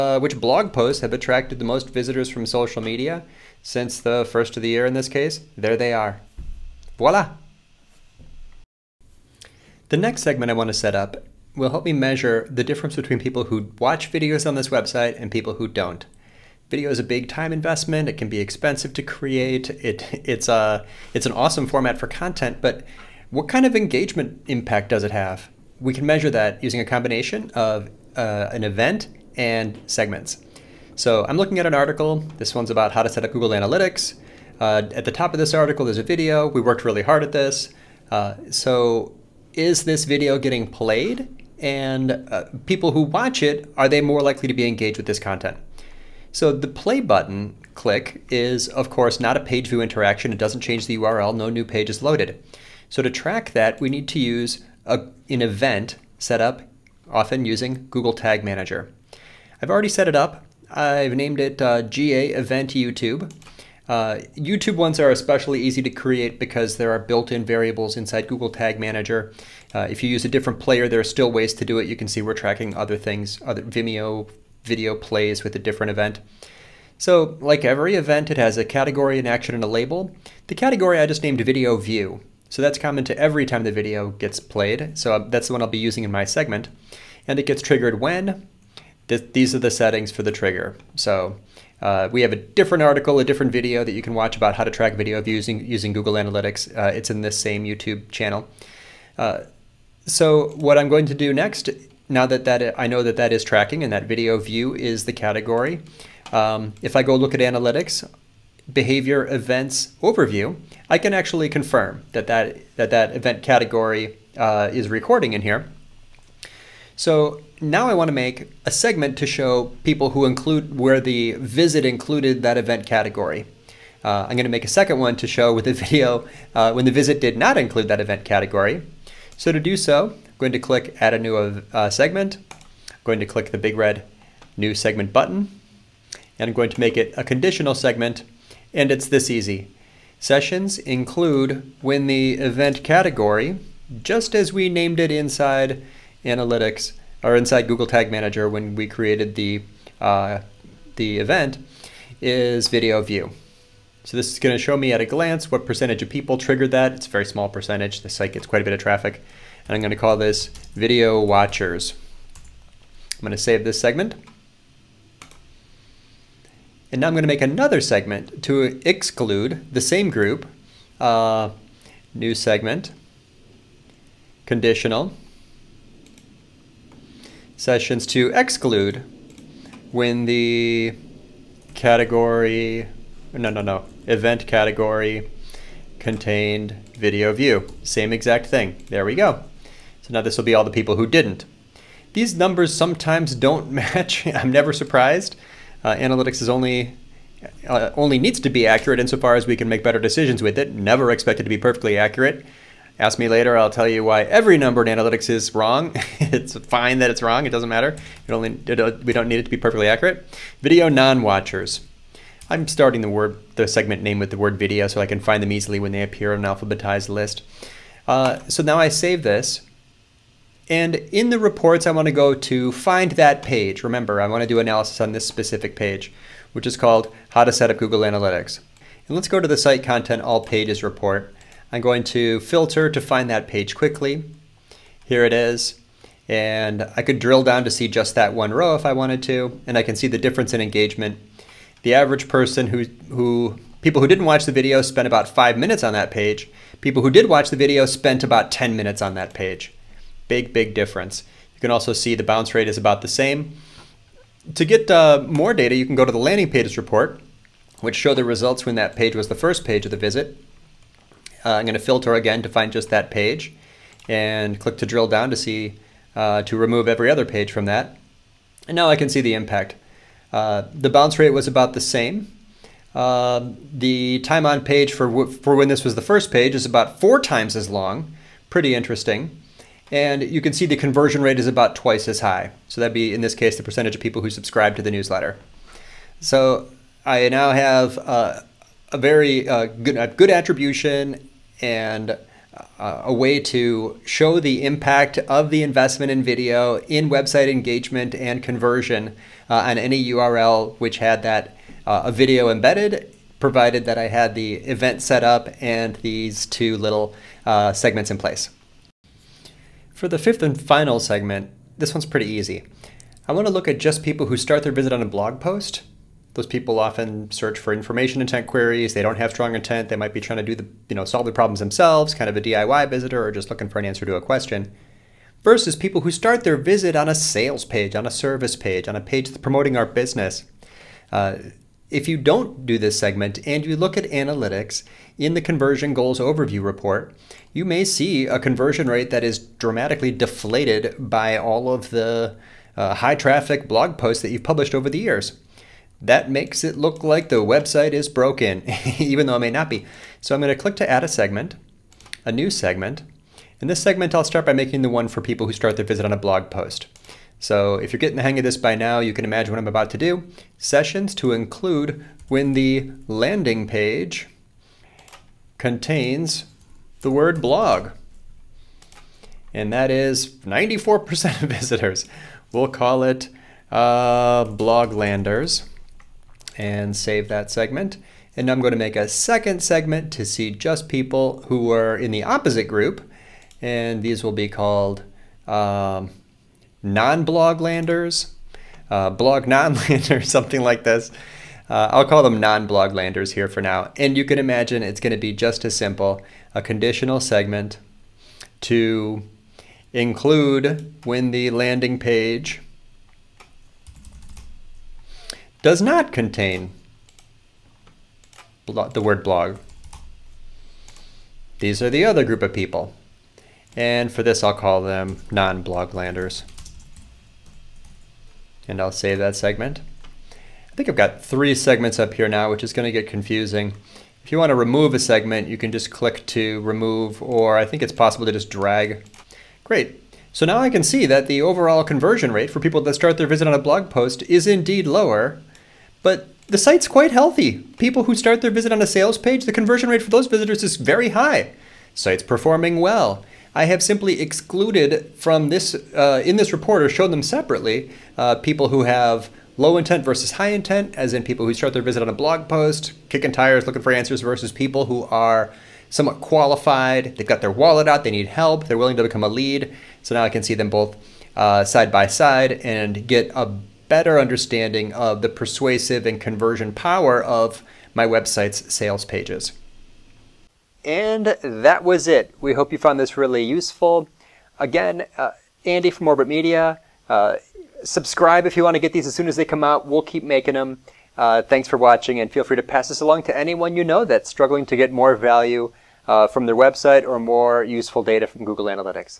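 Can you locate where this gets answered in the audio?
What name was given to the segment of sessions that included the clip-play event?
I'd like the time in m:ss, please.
2:40.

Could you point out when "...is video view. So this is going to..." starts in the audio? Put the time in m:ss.
2:32.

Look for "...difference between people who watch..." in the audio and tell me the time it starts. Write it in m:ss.
0:12.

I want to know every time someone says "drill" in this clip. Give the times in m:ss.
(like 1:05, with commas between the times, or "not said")
3:57, 4:24.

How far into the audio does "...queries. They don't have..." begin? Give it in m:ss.
5:18.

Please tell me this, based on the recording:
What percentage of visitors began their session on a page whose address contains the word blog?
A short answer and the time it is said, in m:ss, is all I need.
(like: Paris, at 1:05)
94%, at 6:10.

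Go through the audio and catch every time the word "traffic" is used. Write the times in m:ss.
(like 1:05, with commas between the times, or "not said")
2:38, 5:43.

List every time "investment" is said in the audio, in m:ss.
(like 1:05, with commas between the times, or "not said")
0:17, 4:55.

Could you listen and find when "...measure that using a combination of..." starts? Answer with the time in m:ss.
0:26.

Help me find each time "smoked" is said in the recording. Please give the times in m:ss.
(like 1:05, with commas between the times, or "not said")
not said.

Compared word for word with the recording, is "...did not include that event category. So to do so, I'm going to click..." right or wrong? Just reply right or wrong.
right.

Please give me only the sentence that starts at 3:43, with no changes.
Remember, I want to do analysis on this specific page, which is called How to Set Up Google Analytics.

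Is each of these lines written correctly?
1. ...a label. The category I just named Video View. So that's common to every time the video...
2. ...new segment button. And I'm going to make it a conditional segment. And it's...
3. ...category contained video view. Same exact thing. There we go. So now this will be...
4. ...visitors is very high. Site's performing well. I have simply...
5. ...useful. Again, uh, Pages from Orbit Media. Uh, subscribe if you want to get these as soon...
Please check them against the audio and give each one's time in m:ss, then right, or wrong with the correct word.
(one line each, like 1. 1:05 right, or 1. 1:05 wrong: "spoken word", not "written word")
1. 1:19 right
2. 2:14 right
3. 3:04 right
4. 7:20 right
5. 7:53 wrong: "Andy", not "Pages".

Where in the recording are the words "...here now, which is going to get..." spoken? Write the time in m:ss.
7:02.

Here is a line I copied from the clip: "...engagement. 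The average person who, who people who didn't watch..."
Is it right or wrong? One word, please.
right.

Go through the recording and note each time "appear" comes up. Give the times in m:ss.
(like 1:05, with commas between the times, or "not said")
3:36.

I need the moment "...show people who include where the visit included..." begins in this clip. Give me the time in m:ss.
1:59.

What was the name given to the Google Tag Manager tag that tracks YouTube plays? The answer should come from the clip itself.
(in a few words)
GA Event YouTube.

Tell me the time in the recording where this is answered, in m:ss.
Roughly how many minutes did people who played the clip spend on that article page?
4:08.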